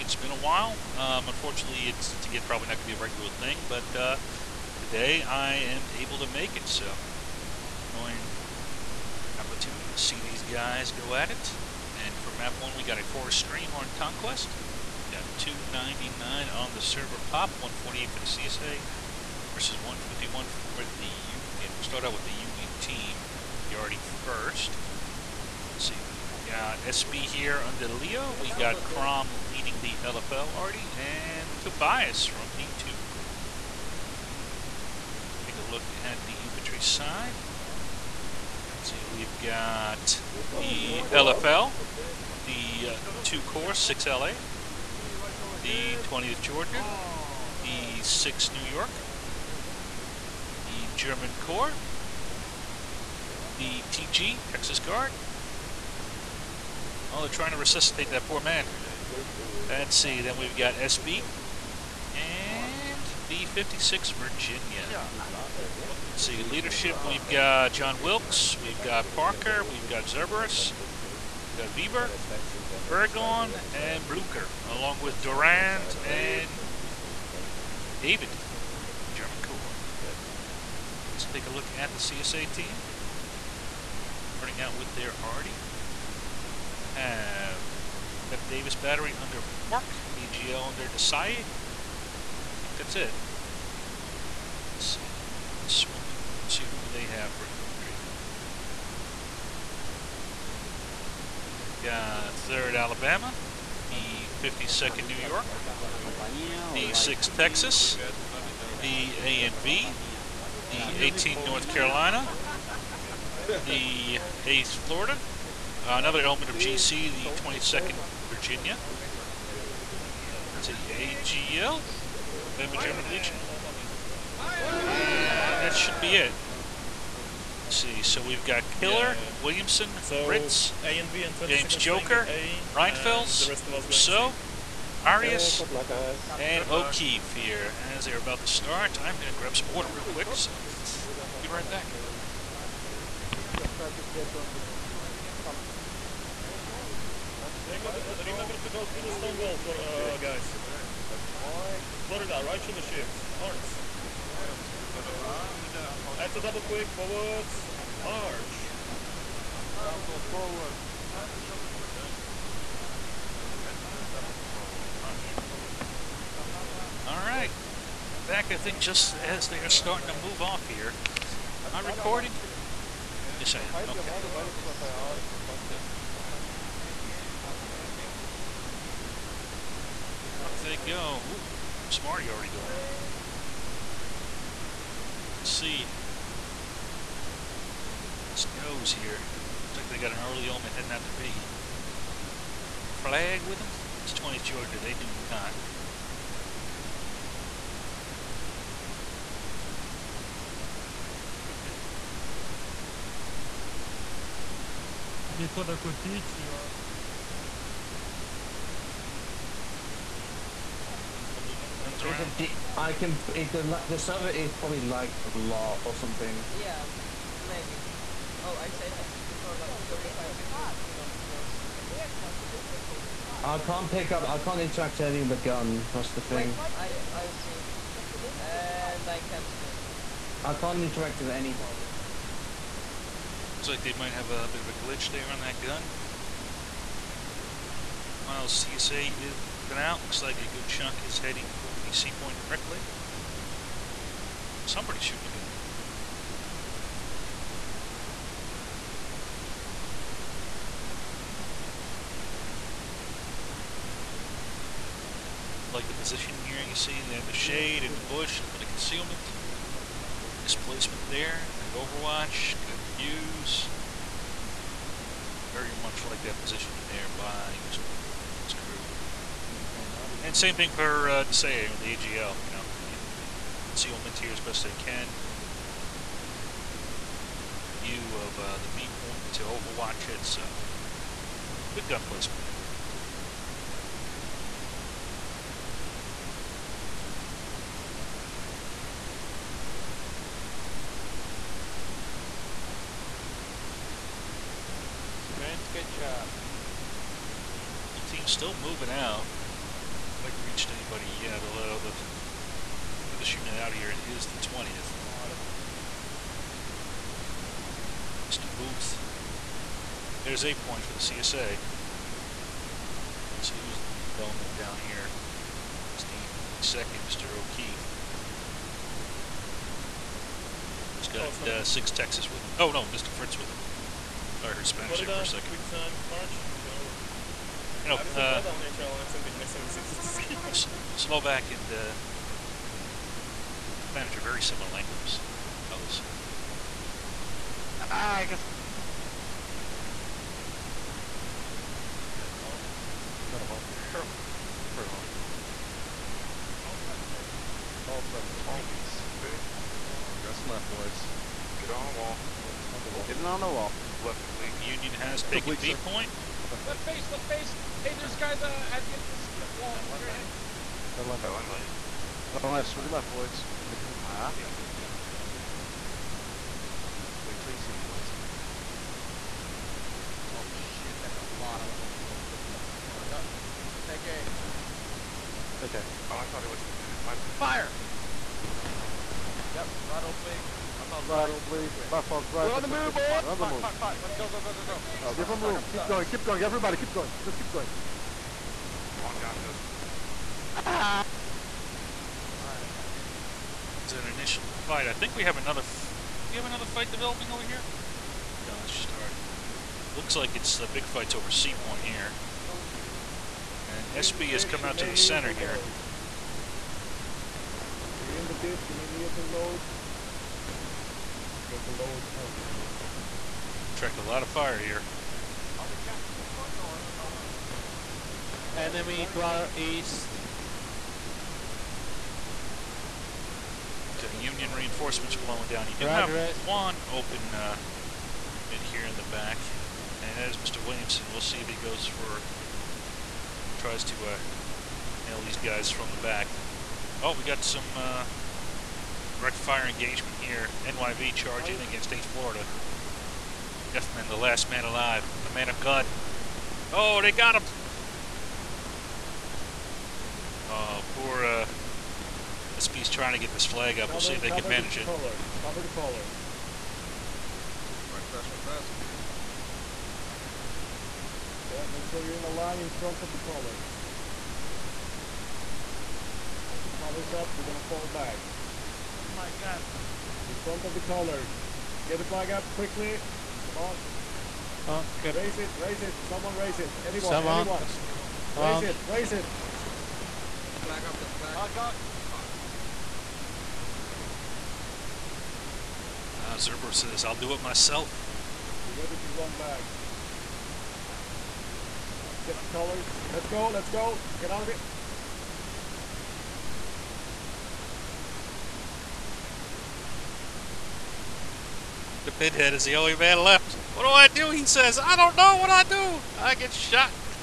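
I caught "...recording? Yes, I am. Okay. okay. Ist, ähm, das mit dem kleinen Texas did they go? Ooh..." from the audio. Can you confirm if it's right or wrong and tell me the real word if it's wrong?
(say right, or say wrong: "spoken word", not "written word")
wrong: "How", not "Texas".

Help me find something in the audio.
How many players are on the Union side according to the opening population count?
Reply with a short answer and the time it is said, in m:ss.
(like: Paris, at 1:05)
151, at 0:19.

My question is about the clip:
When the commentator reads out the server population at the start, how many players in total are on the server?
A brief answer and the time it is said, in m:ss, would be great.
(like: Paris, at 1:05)
299, at 0:15.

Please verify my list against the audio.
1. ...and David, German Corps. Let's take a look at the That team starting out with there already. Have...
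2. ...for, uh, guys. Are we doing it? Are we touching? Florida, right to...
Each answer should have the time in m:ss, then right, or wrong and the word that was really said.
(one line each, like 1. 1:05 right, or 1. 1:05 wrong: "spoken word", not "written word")
1. 1:16 wrong: "CSA", not "That"
2. 2:29 right.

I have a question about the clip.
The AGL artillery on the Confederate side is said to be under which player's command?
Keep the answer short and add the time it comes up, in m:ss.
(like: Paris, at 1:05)
Desai, at 1:30.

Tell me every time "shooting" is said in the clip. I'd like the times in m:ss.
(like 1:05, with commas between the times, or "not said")
4:05, 5:03.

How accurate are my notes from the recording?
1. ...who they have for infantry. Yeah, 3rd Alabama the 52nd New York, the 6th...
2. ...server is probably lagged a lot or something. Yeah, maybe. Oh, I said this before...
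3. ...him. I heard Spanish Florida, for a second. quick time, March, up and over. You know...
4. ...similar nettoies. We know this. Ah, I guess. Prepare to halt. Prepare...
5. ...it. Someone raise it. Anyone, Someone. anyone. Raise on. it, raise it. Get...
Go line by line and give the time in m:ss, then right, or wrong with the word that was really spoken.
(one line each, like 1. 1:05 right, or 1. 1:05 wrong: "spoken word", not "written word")
1. 1:36 right
2. 3:33 right
3. 5:23 right
4. 5:34 wrong: "languages", not "nettoies"
5. 7:55 right.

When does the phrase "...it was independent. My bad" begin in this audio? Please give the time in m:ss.
6:16.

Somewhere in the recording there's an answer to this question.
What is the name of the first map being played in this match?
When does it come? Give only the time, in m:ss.
0:13.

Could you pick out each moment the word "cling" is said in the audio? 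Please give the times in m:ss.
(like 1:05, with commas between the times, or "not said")
not said.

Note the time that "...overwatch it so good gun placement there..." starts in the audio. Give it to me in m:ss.
4:39.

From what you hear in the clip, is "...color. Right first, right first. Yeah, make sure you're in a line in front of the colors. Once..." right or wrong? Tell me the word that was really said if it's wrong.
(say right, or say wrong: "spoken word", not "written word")
right.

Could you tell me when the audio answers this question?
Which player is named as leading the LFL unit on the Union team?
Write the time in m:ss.
0:28.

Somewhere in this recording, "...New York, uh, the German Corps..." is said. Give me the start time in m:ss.
0:48.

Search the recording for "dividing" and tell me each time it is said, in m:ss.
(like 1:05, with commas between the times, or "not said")
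not said.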